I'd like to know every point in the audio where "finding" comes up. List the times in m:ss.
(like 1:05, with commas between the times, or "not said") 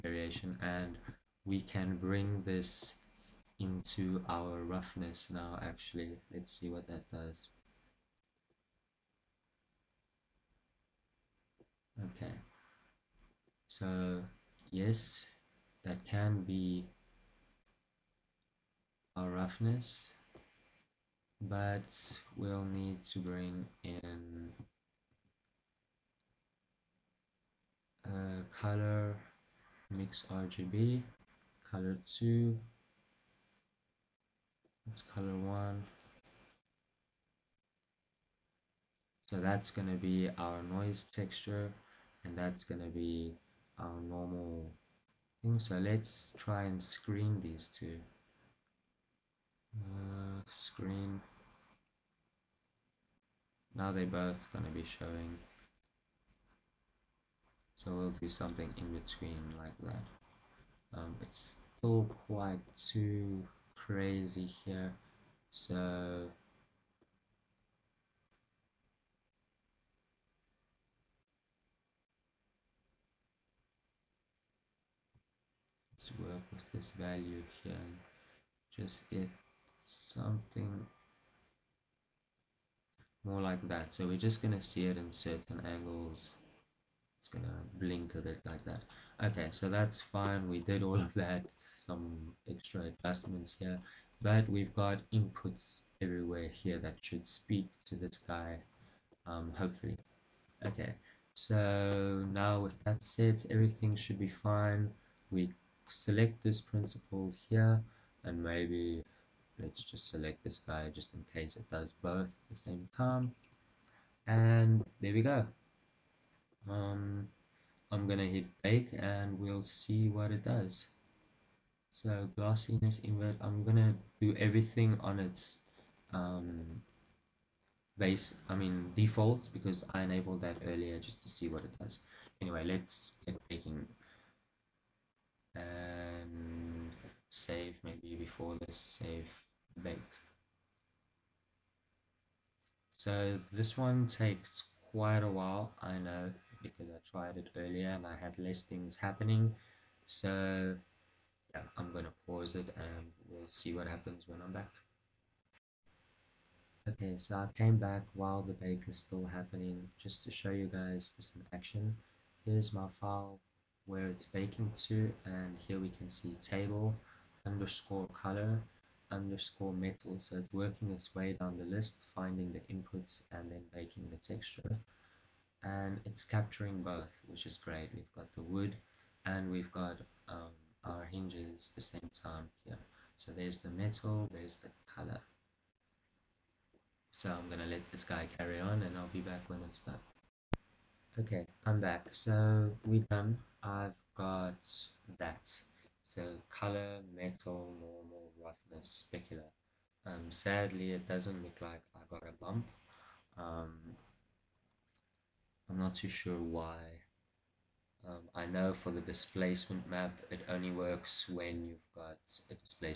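2:52.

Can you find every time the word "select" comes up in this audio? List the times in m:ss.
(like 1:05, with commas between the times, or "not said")
1:45, 1:50.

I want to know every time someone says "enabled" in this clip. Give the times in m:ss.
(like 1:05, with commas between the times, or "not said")
2:10.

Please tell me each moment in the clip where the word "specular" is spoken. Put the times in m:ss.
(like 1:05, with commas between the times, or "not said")
3:19.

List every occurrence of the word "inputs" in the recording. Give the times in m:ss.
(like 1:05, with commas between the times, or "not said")
1:35, 2:52.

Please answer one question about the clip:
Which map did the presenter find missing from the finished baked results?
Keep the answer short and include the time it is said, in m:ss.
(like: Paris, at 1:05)
Bump, at 3:22.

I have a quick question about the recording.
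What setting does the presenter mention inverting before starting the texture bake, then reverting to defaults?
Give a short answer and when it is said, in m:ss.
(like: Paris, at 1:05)
Glossiness, at 2:02.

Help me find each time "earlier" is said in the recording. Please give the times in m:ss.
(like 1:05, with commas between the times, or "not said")
2:10, 2:27.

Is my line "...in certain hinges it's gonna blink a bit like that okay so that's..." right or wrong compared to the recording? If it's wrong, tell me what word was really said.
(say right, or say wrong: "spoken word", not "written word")
wrong: "angles", not "hinges".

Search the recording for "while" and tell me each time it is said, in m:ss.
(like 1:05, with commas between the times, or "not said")
2:25, 2:38.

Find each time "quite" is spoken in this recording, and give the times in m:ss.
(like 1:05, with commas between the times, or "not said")
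1:02, 2:24.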